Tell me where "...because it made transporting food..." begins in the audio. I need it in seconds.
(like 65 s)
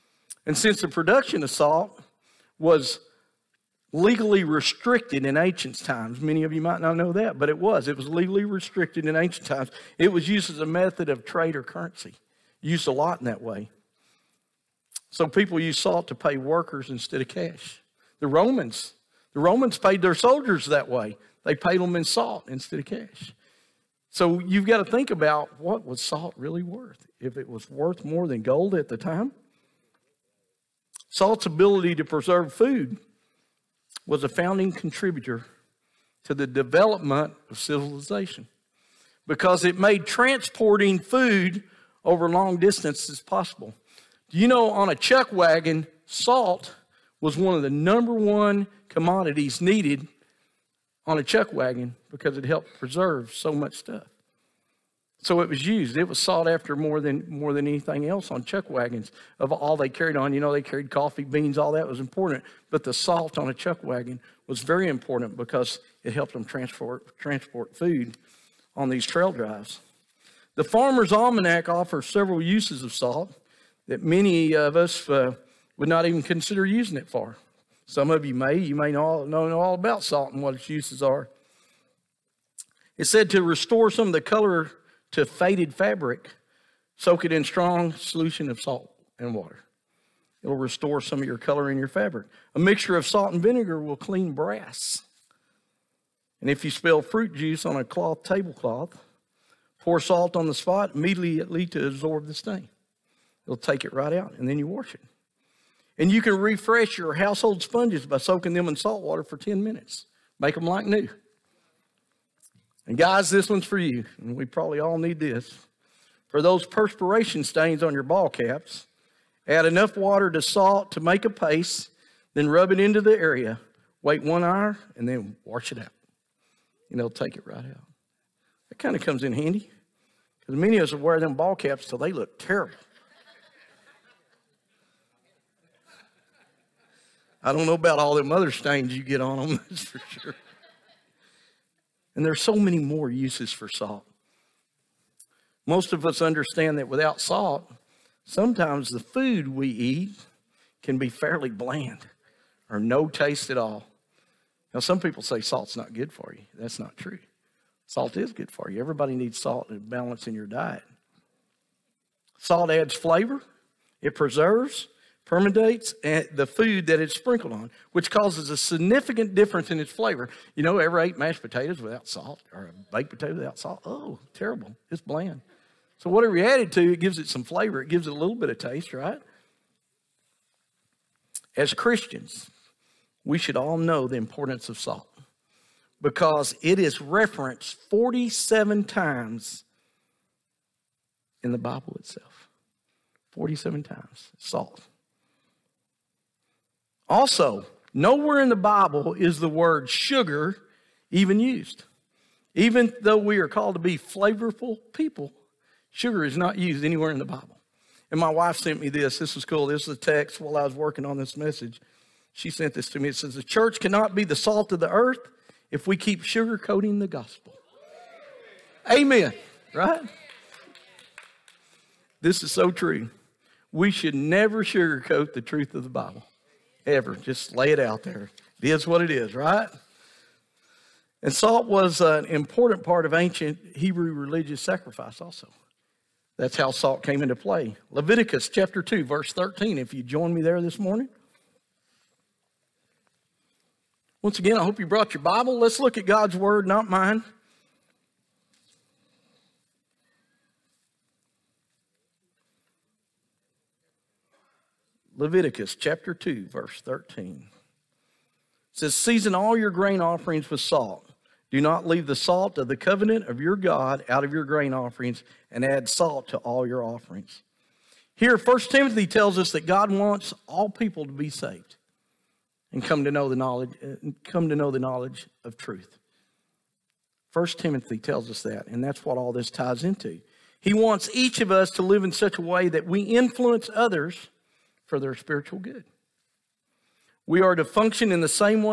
39 s.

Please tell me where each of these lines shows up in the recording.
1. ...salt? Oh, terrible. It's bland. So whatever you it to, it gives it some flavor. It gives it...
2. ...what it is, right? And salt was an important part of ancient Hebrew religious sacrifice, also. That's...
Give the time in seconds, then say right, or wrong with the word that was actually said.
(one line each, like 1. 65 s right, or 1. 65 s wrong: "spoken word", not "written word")
1. 173 s right
2. 228 s right.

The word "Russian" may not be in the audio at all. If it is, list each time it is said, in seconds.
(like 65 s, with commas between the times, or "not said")
not said.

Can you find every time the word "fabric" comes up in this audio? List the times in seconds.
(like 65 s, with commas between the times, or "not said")
85 s, 91 s.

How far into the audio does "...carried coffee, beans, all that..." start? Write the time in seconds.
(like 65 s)
60 s.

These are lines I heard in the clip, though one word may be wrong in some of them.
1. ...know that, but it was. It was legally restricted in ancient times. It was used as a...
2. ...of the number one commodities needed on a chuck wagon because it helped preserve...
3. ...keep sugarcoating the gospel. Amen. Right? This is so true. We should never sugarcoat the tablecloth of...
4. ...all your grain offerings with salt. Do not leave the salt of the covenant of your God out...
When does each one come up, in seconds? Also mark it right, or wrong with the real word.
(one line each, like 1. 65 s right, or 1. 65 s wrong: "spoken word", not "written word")
1. 6 s right
2. 47 s right
3. 215 s wrong: "truth", not "tablecloth"
4. 259 s right.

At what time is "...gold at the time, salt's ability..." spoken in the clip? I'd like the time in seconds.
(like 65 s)
28 s.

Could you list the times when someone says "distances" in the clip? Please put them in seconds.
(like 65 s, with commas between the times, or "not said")
42 s.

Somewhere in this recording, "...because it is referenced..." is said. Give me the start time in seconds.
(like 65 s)
186 s.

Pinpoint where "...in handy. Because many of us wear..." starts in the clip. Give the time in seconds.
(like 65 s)
129 s.